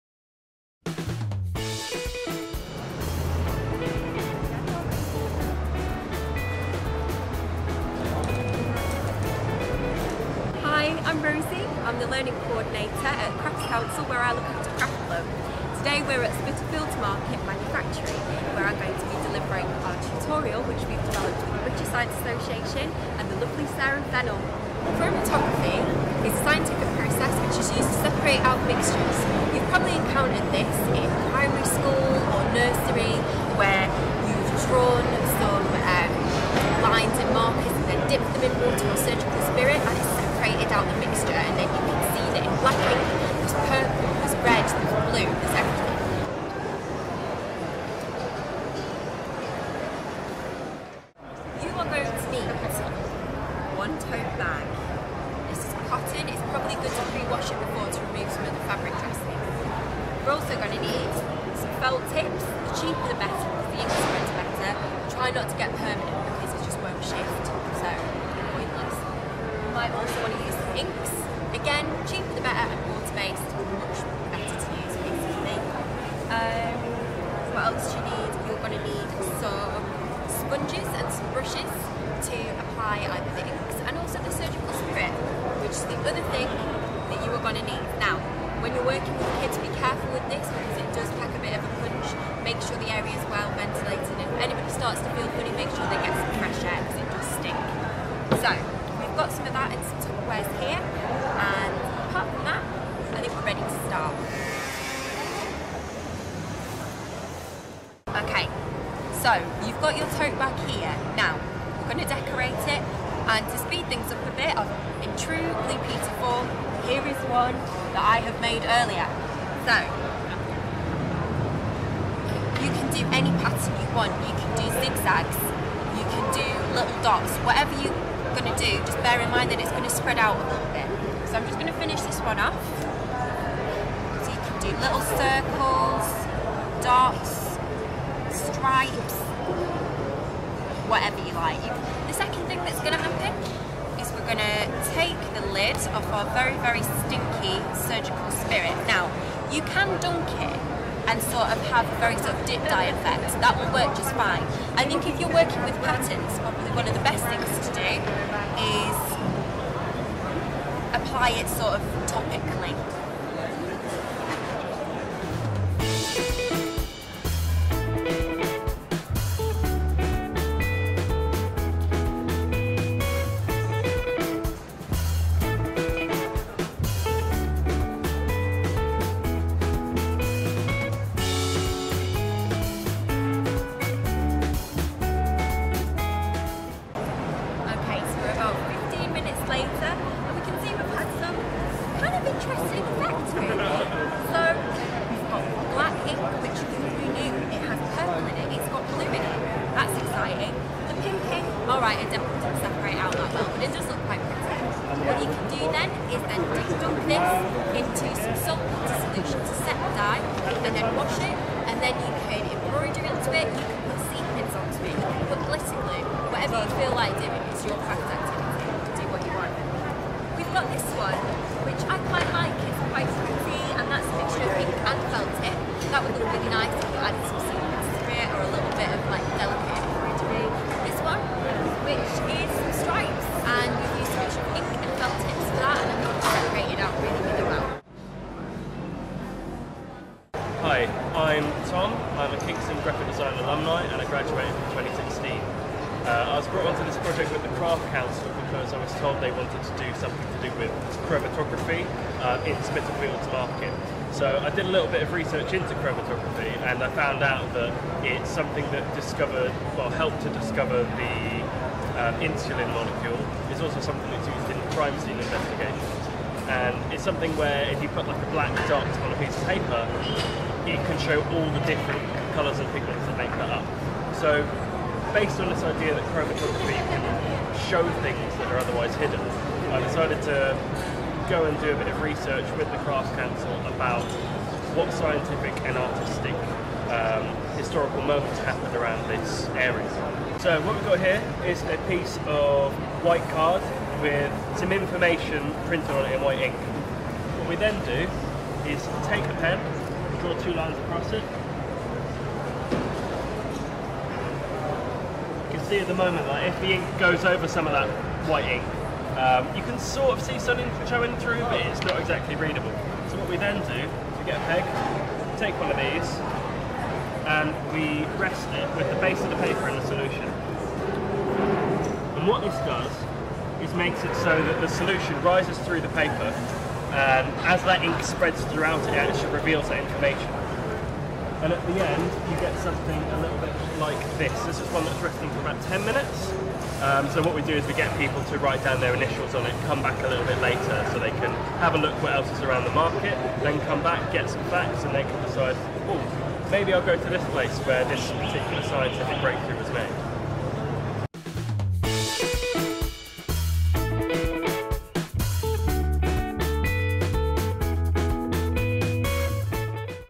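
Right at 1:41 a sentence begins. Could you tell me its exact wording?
And apart from that, I think we're ready to start.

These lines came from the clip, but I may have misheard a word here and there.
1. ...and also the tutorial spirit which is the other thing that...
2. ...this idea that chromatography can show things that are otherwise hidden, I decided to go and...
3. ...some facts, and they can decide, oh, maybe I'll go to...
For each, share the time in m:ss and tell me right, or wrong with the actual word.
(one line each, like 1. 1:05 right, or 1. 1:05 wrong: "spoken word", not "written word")
1. 1:23 wrong: "surgical", not "tutorial"
2. 4:35 right
3. 5:44 right.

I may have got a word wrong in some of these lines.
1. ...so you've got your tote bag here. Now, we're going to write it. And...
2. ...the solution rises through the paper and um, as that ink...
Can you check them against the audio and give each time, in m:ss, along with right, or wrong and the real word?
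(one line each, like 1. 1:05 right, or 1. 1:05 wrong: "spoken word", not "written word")
1. 1:49 wrong: "decorate", not "write"
2. 5:24 right.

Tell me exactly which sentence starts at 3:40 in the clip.
We've got this one, which I quite like, it's quite pretty and that's a mixture of pink and felt tip.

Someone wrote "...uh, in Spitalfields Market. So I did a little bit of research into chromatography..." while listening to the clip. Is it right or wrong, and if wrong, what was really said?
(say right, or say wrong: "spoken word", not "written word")
right.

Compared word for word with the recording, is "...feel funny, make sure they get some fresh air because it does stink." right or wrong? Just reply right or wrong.
right.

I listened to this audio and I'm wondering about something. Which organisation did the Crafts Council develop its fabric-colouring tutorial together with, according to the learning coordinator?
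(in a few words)
British Science Association.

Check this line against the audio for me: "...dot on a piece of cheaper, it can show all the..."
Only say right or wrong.
wrong.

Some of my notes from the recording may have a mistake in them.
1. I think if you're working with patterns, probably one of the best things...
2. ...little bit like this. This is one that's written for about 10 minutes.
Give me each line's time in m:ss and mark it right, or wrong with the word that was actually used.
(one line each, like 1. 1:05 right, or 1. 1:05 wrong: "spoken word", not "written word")
1. 2:34 right
2. 5:33 right.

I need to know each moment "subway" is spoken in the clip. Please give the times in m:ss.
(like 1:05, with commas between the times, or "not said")
not said.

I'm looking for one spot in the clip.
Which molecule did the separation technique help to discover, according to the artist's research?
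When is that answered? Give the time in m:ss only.
4:22.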